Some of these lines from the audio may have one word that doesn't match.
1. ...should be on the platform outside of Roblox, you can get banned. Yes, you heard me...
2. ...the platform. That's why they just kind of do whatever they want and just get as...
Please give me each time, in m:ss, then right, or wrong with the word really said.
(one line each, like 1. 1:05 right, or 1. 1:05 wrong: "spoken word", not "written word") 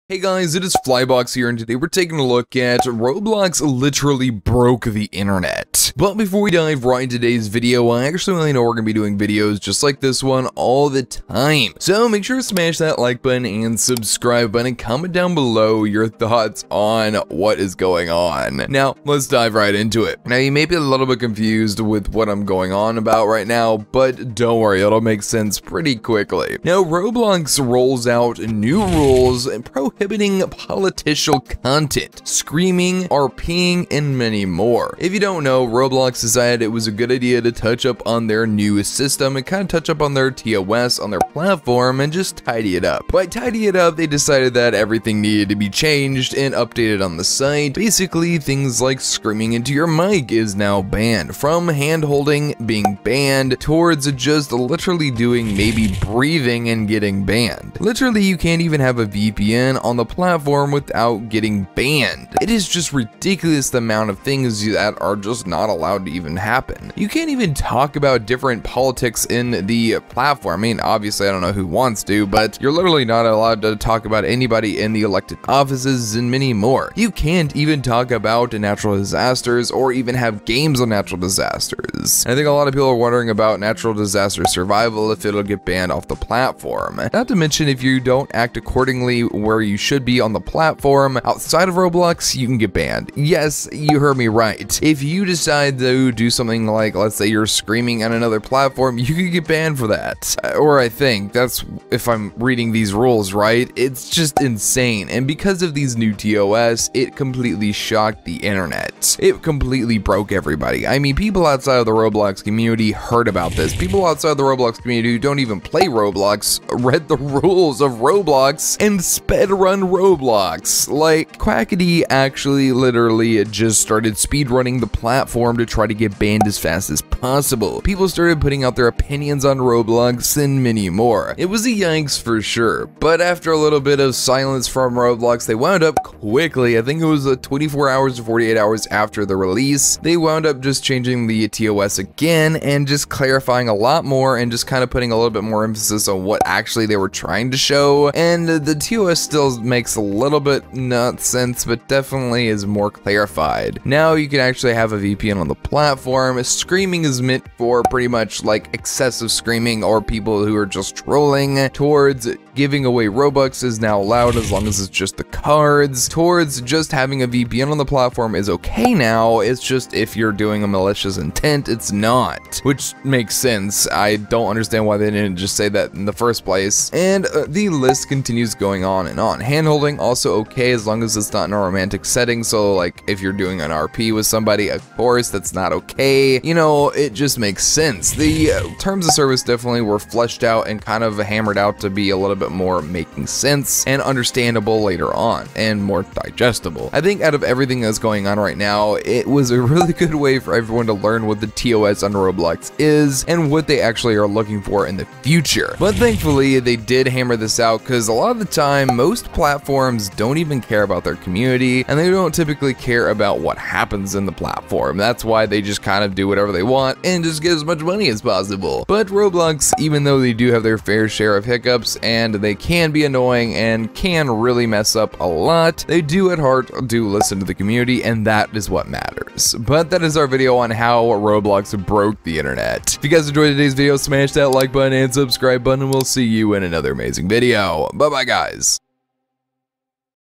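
1. 1:29 right
2. 3:34 right.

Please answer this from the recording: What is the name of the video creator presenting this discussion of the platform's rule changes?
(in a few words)
Flybox.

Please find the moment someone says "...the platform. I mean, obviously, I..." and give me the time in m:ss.
1:09.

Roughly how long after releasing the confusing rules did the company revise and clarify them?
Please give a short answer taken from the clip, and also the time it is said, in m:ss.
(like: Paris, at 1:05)
24 to 48 hours, at 2:17.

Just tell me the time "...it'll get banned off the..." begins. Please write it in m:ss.
1:25.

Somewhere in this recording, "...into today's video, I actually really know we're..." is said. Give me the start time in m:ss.
0:07.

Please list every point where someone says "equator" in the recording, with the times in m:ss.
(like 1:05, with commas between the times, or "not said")
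not said.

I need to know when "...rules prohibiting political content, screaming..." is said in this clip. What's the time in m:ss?
0:28.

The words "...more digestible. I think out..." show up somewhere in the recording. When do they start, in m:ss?
3:15.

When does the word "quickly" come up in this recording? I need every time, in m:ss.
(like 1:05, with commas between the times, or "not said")
0:25, 2:16.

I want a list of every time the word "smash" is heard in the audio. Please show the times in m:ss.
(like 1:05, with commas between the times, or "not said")
0:12, 3:53.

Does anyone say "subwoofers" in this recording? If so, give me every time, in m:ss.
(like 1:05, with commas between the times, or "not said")
not said.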